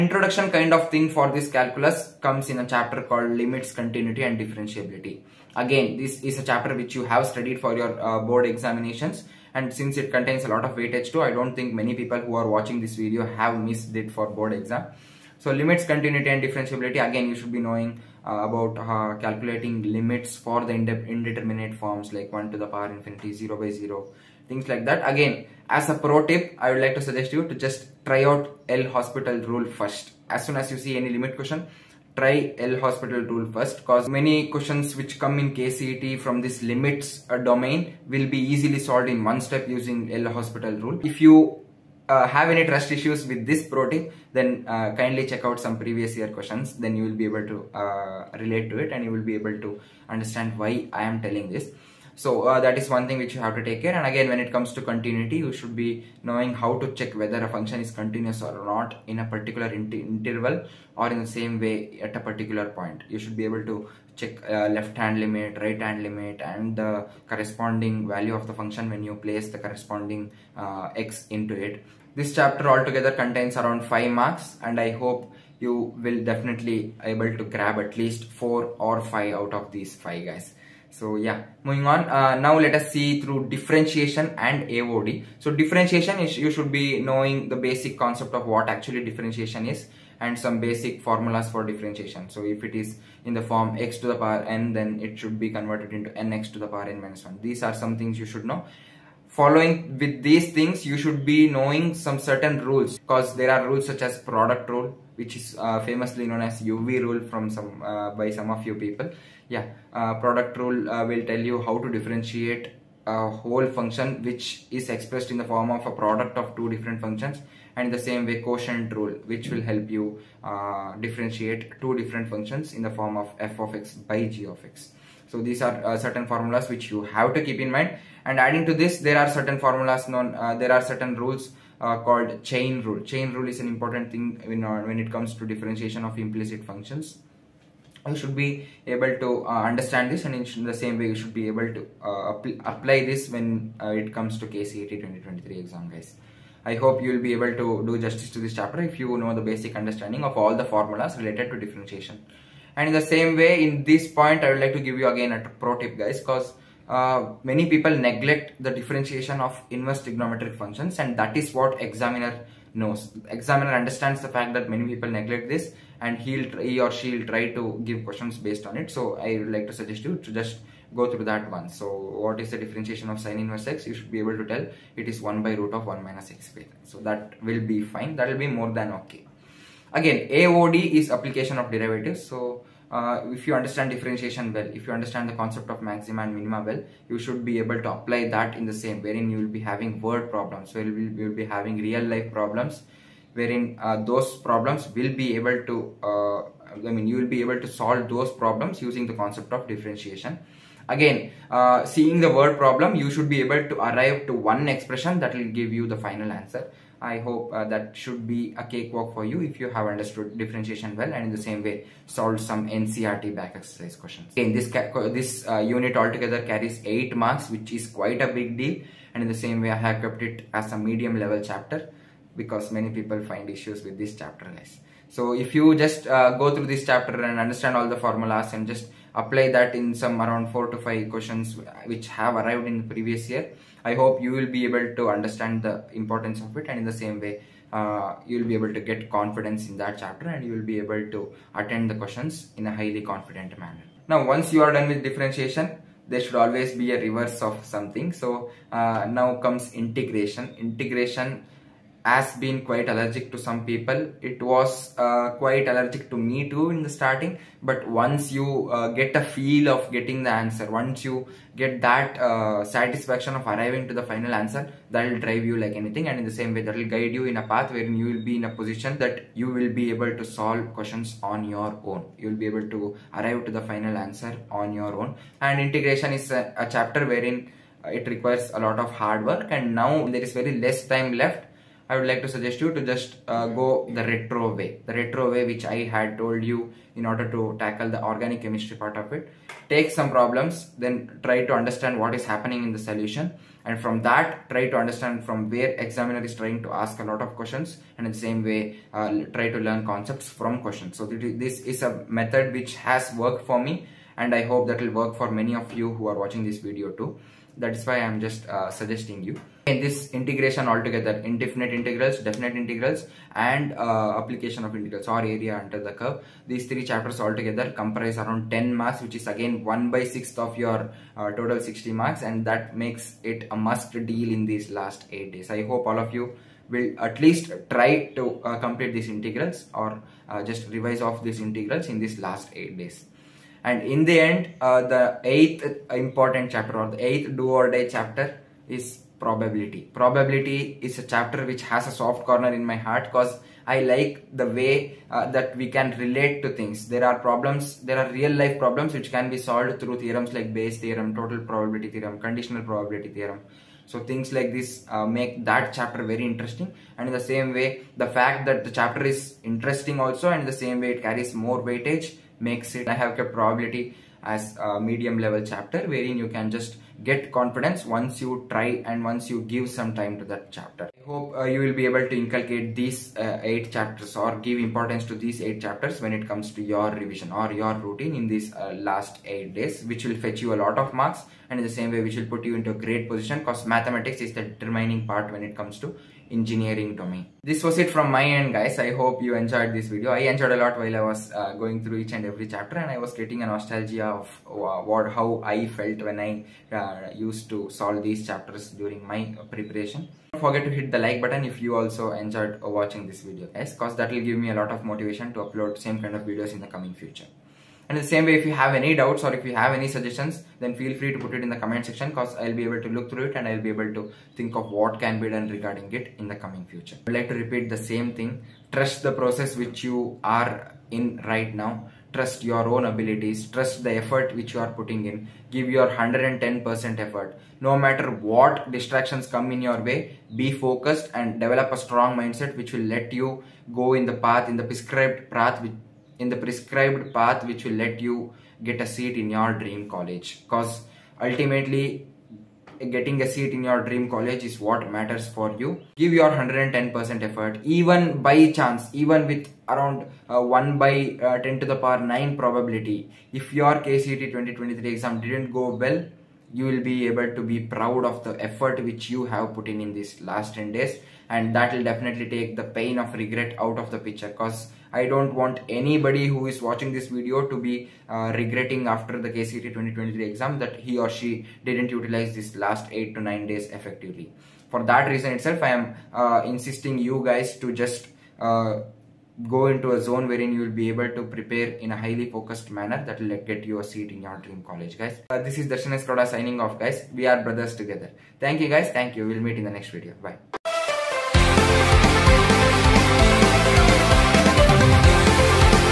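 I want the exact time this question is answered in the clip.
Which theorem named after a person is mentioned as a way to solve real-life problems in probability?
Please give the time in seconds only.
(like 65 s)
350 s.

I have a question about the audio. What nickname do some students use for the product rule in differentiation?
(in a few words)
uv rule.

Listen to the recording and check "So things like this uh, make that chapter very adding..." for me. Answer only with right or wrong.
wrong.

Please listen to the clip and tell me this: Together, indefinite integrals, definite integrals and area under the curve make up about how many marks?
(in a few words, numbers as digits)
10.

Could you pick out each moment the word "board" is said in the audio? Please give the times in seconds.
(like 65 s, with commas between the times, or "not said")
8 s, 14 s.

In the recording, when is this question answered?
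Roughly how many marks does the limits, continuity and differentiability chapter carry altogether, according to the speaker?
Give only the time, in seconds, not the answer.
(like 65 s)
73 s.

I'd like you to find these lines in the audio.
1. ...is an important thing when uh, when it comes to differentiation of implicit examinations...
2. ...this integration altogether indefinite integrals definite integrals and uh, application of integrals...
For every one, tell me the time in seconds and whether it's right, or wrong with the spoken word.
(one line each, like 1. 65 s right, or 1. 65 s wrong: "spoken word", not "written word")
1. 133 s wrong: "functions", not "examinations"
2. 309 s right.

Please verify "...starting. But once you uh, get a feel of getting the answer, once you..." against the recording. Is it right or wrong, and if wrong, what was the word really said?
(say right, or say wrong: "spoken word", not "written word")
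right.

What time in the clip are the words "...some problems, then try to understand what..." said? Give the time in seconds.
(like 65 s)
289 s.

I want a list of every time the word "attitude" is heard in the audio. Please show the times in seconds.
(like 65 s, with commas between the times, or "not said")
not said.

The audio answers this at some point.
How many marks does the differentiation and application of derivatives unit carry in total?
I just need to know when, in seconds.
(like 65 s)
216 s.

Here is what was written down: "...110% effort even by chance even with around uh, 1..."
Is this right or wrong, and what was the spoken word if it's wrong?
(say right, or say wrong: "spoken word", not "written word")
right.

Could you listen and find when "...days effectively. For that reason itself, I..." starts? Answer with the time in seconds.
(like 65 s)
473 s.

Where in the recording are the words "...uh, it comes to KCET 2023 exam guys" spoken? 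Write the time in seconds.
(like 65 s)
143 s.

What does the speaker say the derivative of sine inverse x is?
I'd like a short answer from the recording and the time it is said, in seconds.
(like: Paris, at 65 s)
1 by root of 1 minus x squared, at 175 s.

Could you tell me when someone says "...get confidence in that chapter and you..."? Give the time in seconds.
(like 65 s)
238 s.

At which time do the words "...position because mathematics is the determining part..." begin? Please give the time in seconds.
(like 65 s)
383 s.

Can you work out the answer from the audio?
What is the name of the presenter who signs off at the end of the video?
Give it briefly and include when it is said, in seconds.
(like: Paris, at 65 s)
Darshan S Gowda, at 485 s.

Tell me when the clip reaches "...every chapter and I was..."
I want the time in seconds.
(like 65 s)
392 s.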